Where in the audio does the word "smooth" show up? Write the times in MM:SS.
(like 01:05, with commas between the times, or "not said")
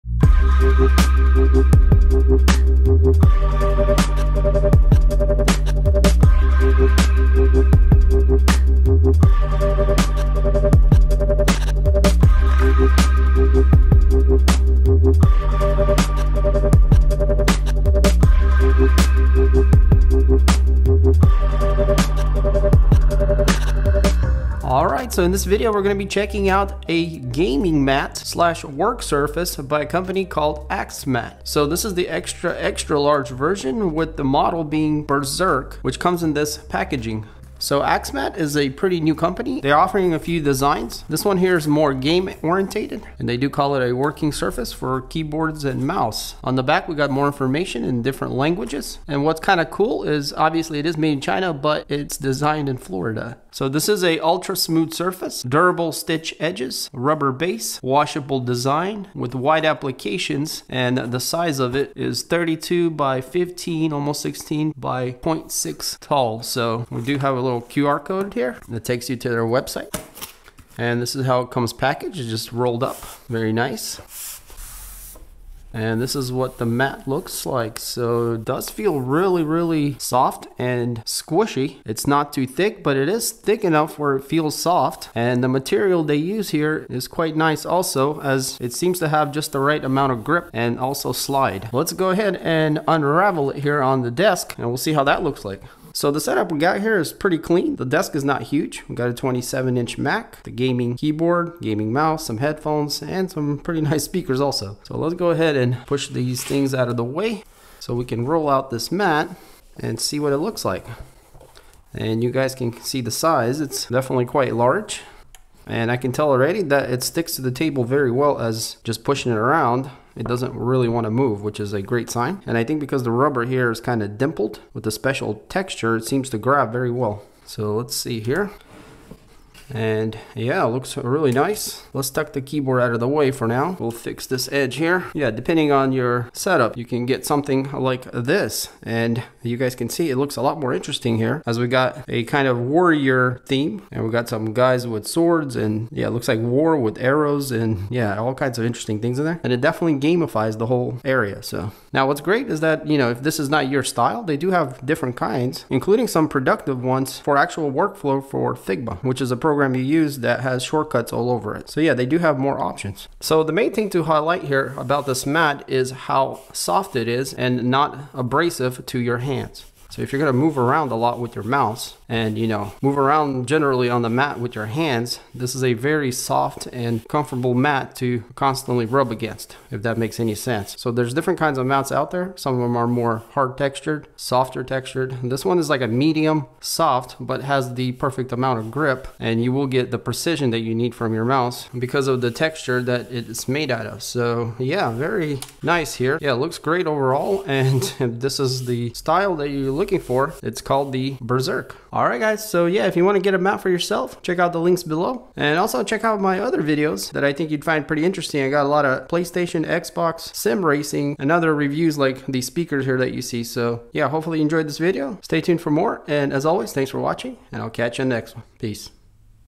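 00:54.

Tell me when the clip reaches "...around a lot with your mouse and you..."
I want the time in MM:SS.
02:50.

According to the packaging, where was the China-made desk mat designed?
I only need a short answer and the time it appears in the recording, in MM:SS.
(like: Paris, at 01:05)
Florida, at 00:52.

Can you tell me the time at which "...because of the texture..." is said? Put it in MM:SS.
03:11.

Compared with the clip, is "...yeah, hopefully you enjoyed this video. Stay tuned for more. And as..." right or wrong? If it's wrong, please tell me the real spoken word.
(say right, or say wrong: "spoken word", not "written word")
right.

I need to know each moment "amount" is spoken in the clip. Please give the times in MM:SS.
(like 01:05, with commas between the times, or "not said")
01:29, 03:08.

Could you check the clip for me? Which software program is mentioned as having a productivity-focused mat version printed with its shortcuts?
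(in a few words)
Figma.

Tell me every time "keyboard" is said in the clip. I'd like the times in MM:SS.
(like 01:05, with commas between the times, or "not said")
00:45, 01:40, 02:12.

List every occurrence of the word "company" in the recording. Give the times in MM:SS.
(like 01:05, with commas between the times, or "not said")
00:29, 00:39.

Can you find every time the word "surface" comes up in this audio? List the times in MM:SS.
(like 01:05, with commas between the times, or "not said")
00:29, 00:44, 00:54.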